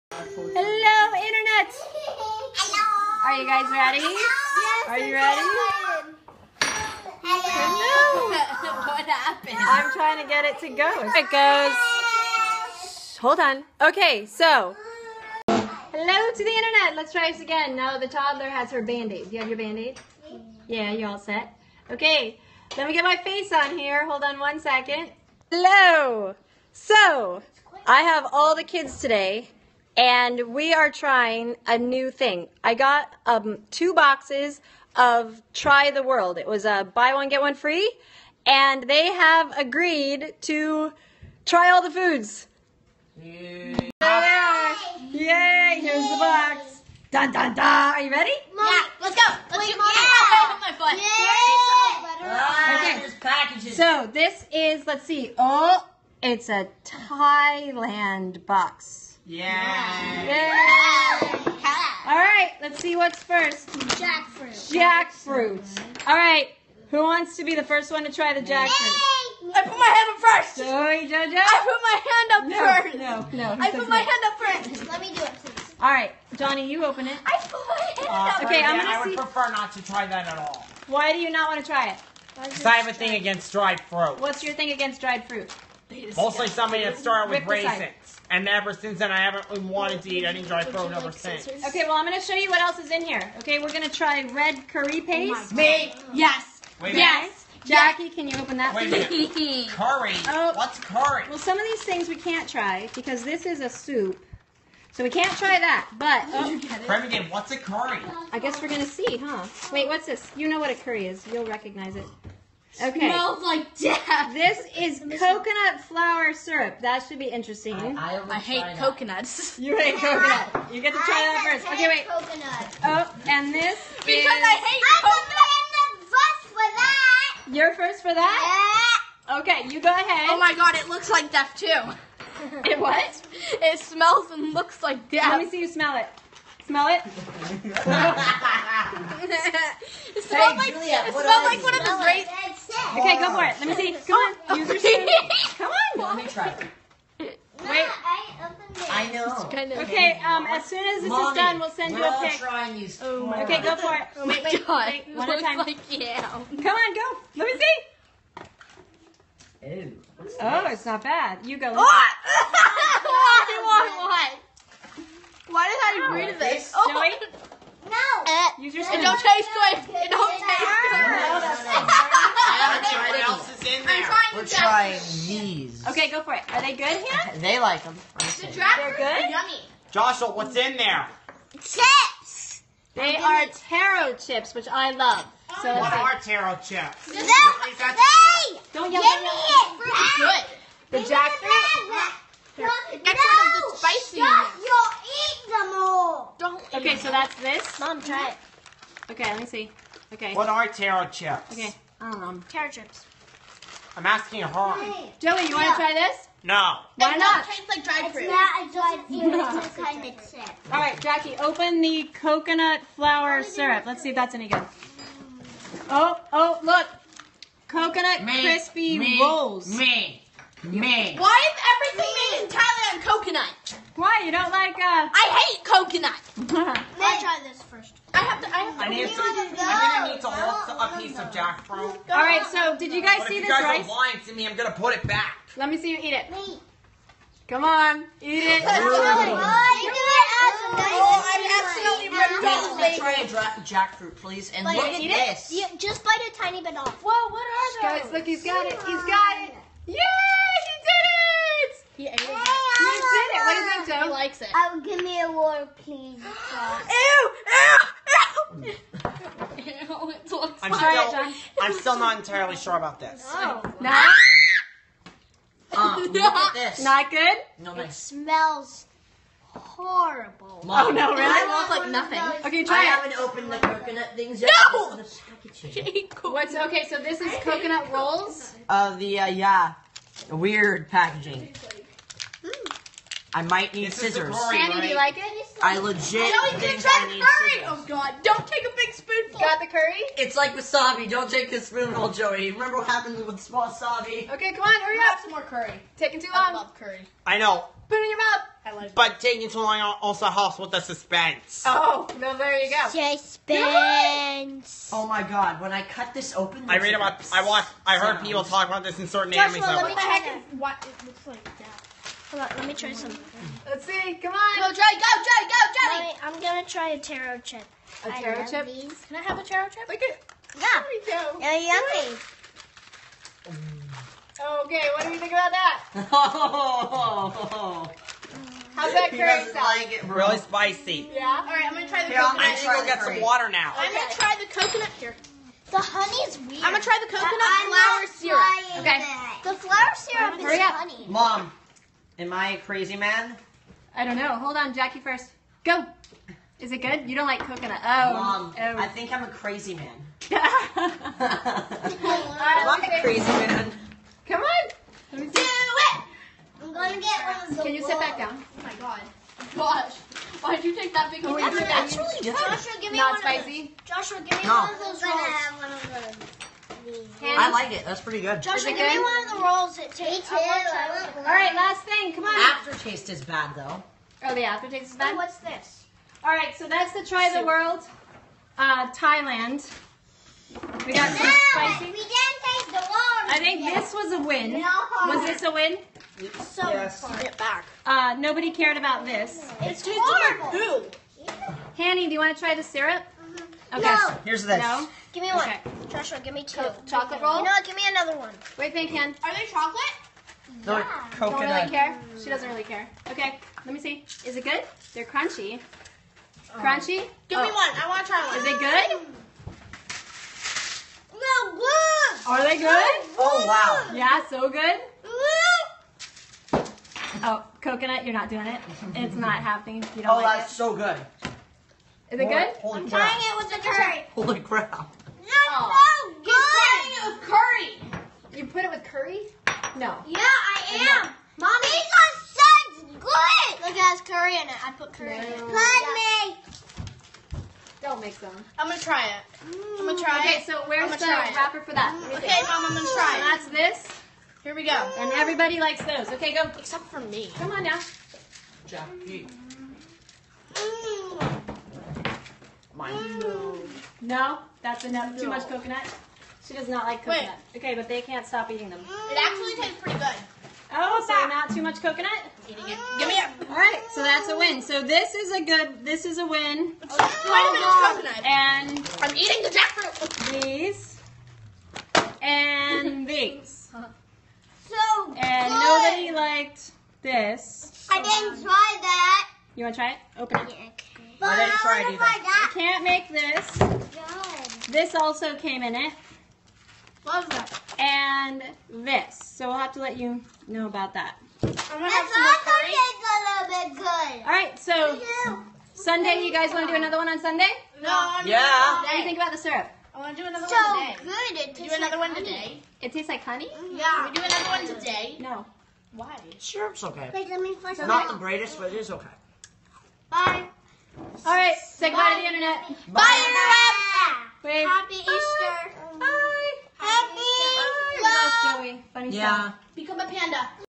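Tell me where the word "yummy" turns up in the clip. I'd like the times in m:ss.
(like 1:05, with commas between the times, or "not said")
2:59, 5:21.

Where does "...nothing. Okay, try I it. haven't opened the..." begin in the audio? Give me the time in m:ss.
4:31.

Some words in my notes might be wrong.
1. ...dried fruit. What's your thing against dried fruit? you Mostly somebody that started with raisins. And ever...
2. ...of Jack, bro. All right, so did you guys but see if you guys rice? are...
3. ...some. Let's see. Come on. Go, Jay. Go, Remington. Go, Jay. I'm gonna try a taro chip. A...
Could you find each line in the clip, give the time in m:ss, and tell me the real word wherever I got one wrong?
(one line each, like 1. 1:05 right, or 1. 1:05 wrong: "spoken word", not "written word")
1. 1:23 right
2. 3:51 right
3. 5:12 wrong: "Jay", not "Remington".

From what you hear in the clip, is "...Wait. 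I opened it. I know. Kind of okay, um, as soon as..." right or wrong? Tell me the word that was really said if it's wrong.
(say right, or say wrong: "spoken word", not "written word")
right.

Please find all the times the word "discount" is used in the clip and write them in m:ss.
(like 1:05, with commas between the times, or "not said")
not said.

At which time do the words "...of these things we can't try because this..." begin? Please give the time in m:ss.
1:41.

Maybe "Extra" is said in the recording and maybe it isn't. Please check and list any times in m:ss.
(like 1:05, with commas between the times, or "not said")
3:12.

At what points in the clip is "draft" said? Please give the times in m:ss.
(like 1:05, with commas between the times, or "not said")
2:58.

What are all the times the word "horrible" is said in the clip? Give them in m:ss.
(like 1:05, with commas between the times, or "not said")
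4:29, 6:29.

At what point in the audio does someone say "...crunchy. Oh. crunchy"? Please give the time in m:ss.
6:45.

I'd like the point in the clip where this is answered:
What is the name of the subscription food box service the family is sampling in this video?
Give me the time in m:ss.
0:35.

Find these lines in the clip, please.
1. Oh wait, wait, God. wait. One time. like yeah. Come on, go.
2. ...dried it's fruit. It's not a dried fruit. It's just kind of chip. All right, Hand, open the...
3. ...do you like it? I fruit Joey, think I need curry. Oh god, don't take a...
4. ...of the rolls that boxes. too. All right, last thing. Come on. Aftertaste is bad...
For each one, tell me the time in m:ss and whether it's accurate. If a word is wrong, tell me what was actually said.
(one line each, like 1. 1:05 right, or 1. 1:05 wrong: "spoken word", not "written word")
1. 2:34 right
2. 3:27 wrong: "Jackie", not "Hand"
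3. 4:44 wrong: "legit", not "fruit"
4. 6:09 wrong: "tastes", not "boxes".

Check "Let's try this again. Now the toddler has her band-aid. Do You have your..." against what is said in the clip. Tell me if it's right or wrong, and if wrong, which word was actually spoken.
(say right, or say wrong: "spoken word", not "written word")
right.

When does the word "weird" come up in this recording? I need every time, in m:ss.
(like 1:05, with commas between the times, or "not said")
4:40, 5:36.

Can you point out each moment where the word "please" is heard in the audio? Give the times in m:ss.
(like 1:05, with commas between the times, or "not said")
1:15, 4:04, 4:15.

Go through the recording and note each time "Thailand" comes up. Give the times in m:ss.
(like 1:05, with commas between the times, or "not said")
0:56, 3:42, 6:18.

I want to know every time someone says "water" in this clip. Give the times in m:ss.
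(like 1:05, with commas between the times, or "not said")
4:15, 5:33.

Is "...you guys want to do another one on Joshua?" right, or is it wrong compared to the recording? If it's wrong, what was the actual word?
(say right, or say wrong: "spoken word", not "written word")
wrong: "Sunday", not "Joshua".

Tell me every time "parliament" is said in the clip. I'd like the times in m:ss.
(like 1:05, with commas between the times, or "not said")
not said.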